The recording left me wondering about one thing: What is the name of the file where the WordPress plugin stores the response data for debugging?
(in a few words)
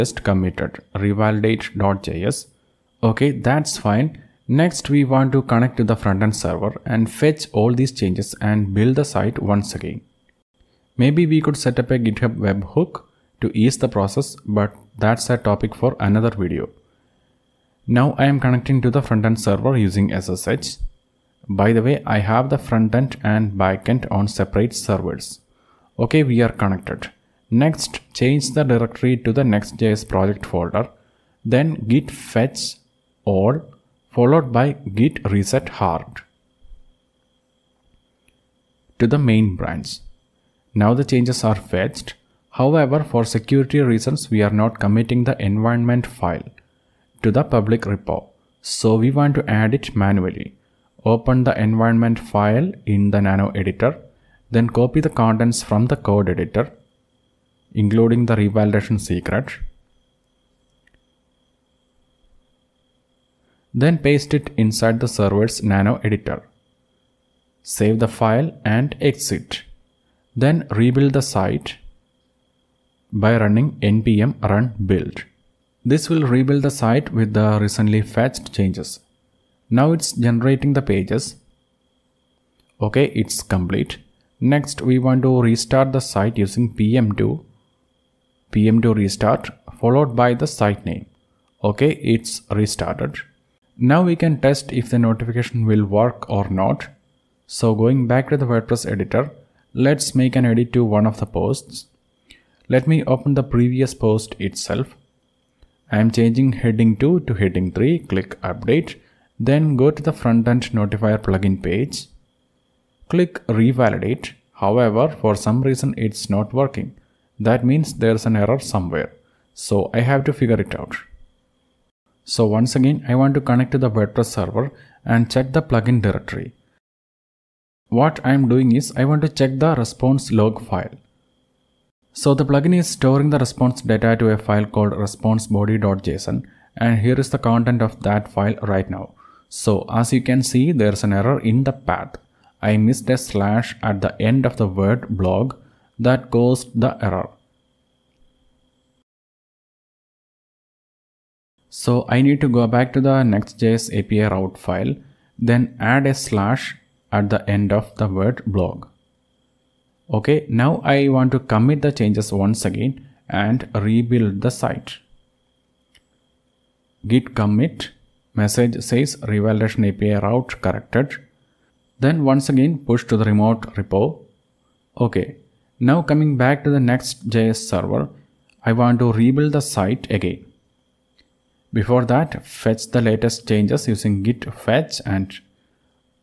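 response_body.json.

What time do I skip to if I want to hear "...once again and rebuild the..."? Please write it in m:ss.
2:42.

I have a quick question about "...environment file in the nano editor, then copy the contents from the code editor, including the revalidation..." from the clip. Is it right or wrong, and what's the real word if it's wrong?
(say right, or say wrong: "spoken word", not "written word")
right.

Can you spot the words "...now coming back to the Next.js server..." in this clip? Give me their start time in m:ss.
2:55.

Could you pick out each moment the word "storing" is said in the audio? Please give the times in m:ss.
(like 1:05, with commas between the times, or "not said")
2:12.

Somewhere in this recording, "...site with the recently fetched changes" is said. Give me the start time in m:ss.
1:16.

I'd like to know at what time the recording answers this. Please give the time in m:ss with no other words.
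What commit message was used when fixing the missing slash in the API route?
2:49.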